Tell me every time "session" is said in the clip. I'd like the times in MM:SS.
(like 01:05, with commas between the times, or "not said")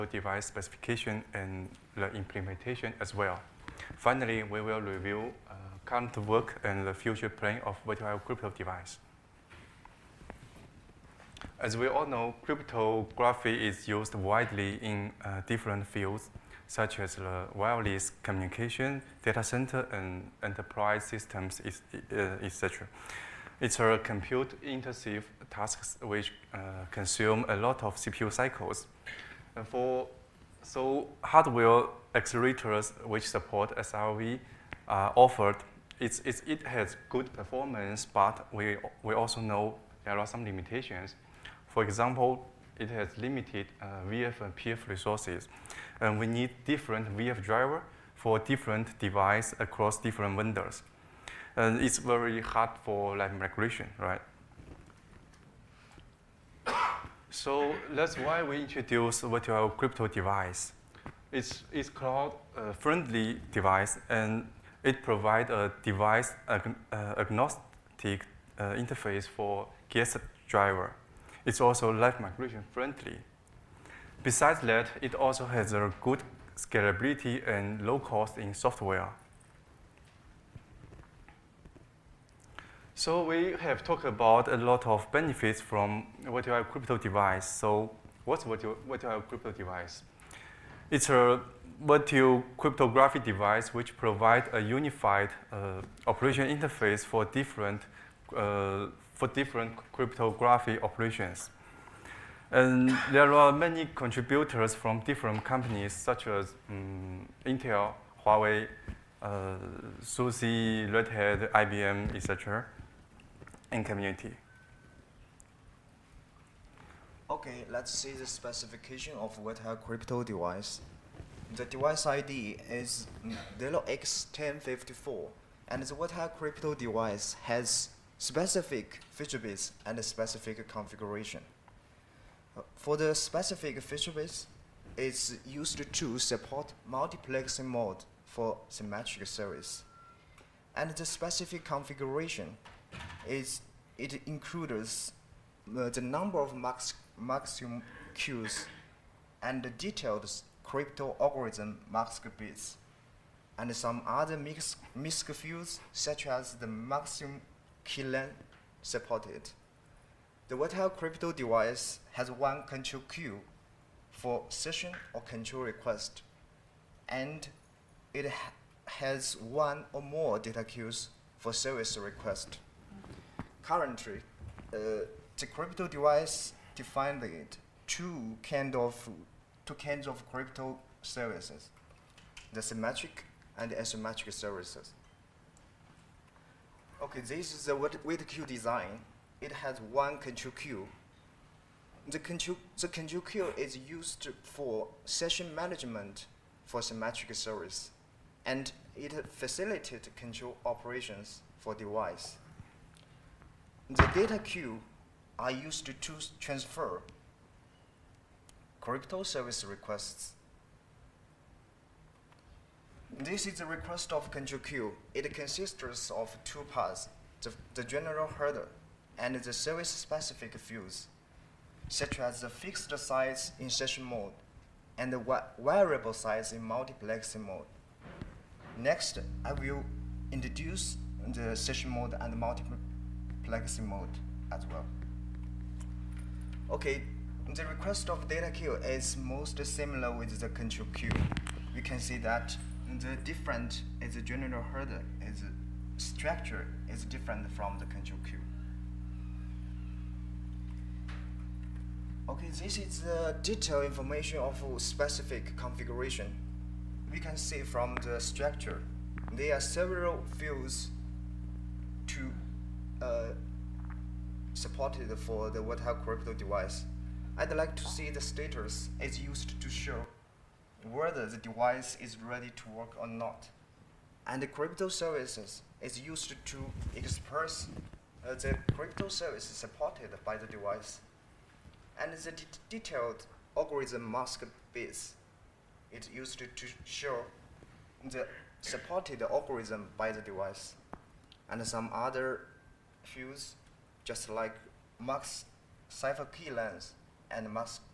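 02:44, 03:15, 03:43, 03:51.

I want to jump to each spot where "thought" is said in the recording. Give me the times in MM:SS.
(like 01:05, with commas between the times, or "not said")
not said.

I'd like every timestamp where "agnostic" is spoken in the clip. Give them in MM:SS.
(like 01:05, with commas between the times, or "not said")
01:07.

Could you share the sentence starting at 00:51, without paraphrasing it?
And it's very hard for like migration, right?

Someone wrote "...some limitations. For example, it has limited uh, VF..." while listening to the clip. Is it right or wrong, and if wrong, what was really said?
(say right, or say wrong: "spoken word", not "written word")
right.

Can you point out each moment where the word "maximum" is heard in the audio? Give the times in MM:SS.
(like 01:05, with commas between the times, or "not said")
02:27, 02:36.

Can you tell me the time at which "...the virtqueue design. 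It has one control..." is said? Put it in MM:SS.
03:07.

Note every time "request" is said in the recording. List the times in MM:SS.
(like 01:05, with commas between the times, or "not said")
02:45, 02:51, 03:29, 03:33, 03:57.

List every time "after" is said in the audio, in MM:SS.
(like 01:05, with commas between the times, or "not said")
not said.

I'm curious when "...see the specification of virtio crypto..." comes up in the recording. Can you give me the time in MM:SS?
01:57.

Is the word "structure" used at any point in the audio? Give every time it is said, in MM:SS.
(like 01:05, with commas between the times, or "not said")
04:05, 04:18.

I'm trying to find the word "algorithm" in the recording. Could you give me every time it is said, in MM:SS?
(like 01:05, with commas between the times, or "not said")
02:31, 04:43, 04:49.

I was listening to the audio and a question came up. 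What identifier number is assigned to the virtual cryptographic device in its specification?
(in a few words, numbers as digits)
0x1054.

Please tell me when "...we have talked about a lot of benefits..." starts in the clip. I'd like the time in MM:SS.
01:23.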